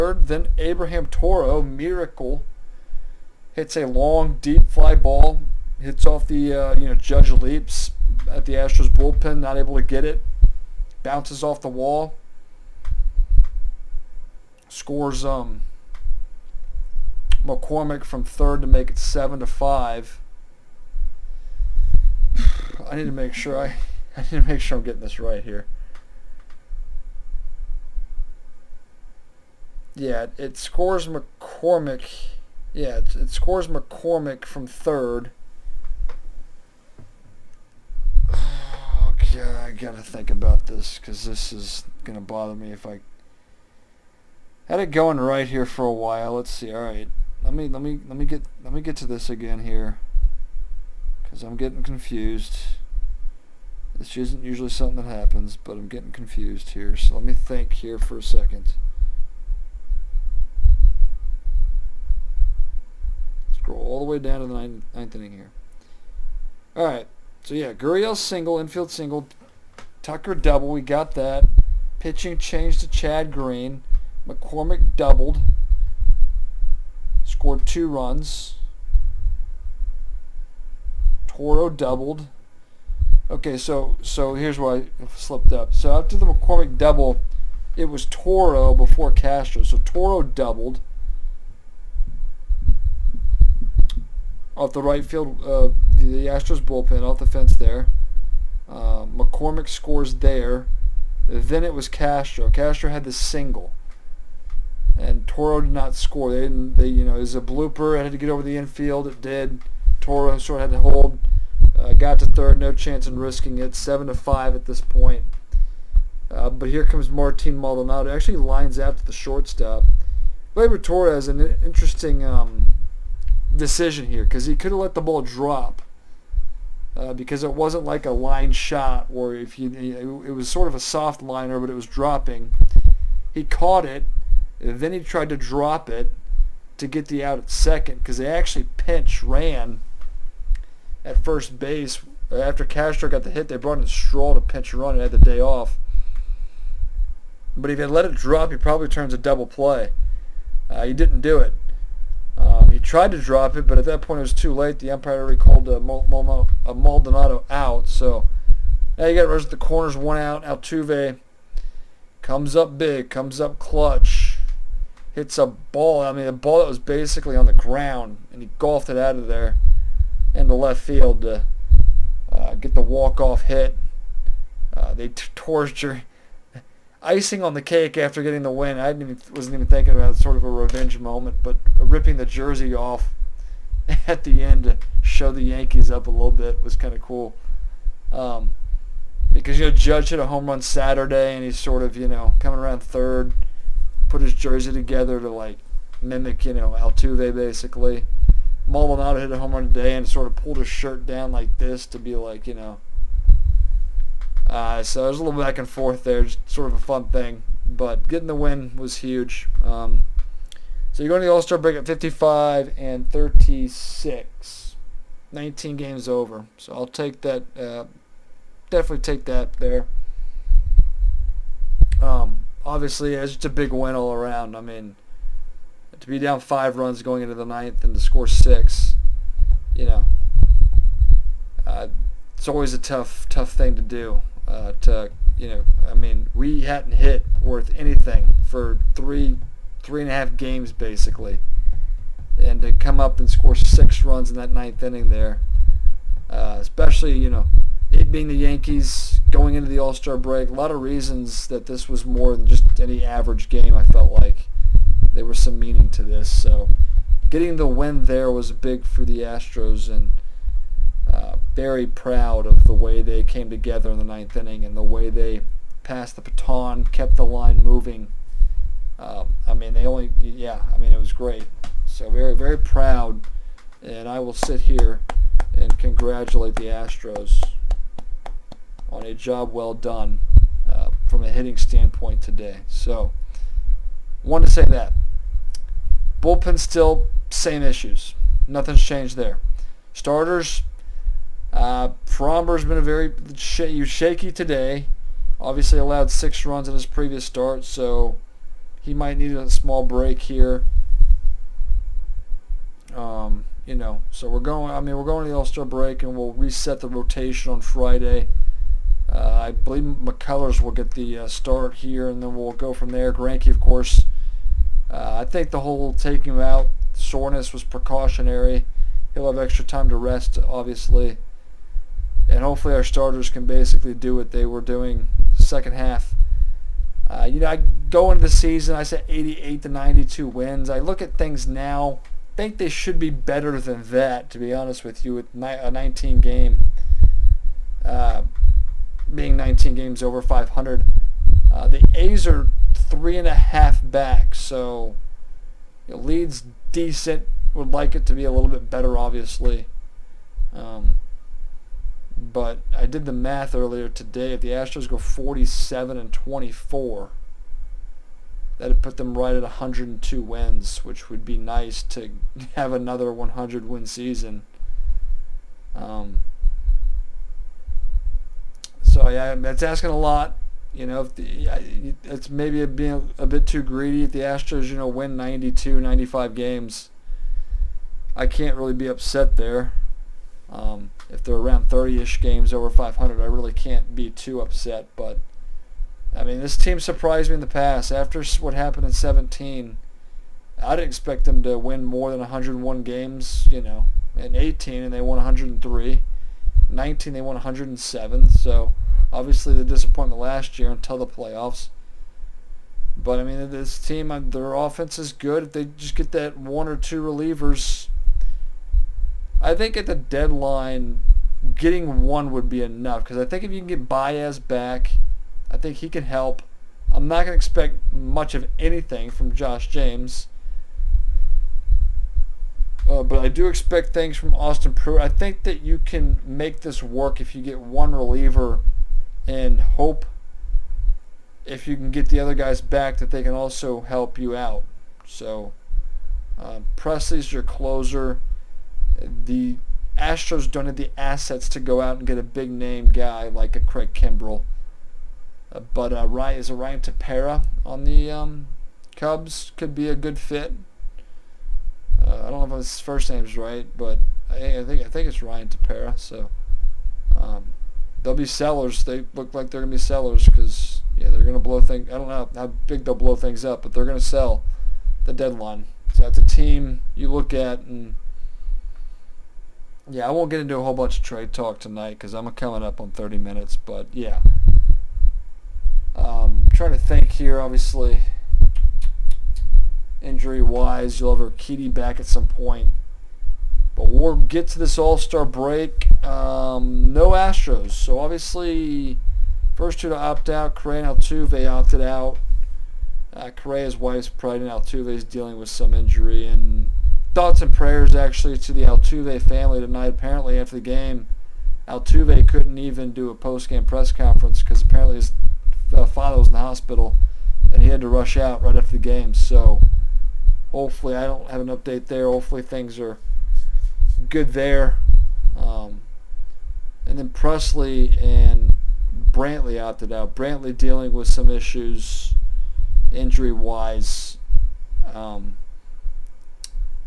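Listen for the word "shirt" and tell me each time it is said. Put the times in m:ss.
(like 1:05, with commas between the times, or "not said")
3:20.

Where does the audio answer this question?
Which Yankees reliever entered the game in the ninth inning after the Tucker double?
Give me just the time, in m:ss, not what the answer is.
1:12.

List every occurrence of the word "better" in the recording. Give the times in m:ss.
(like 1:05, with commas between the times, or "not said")
5:33, 5:48.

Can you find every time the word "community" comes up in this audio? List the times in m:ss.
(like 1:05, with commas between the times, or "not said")
not said.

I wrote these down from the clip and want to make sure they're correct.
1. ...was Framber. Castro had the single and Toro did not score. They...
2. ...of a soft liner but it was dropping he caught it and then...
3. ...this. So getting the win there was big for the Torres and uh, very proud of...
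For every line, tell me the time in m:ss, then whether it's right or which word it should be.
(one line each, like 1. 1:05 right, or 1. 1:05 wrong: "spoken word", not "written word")
1. 1:41 wrong: "Castro", not "Framber"
2. 2:10 right
3. 4:16 wrong: "Astros", not "Torres".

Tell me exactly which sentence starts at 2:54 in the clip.
Uh, they torture, icing on the cake after getting the win.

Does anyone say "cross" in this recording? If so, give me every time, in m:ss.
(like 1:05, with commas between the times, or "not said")
not said.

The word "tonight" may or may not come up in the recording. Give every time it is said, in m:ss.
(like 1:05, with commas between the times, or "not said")
7:51, 8:19.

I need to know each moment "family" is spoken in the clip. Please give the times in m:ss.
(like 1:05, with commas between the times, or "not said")
8:19.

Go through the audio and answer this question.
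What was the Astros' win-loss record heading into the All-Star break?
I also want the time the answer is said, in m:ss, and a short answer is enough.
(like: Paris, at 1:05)
55 and 36, at 3:31.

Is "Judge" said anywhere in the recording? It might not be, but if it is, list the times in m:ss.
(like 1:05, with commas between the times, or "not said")
0:06, 3:09.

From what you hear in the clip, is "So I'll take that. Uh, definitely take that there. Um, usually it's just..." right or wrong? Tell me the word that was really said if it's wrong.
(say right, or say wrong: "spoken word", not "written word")
wrong: "obviously", not "usually".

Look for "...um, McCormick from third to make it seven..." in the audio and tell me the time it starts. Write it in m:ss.
0:15.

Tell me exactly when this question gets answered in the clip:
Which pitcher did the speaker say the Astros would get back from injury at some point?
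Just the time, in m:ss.
8:01.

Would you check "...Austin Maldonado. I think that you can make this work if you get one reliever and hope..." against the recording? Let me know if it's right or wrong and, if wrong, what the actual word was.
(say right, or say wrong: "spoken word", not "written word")
wrong: "Pruitt", not "Maldonado".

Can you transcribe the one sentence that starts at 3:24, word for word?
Uh, so there's a little back and forth there, just sort of a fun thing.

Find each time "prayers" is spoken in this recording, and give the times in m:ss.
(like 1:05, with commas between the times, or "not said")
8:17.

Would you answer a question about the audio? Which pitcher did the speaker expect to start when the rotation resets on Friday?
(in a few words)
McCullers.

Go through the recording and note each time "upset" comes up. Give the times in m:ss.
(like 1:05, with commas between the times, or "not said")
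6:18, 6:24.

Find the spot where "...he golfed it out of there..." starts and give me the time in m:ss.
2:48.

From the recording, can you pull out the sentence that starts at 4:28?
Um, I mean, they only, yeah, I mean, it was great.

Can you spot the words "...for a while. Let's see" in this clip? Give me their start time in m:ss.
0:45.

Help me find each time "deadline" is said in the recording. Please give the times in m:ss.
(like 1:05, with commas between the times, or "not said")
6:49, 7:45.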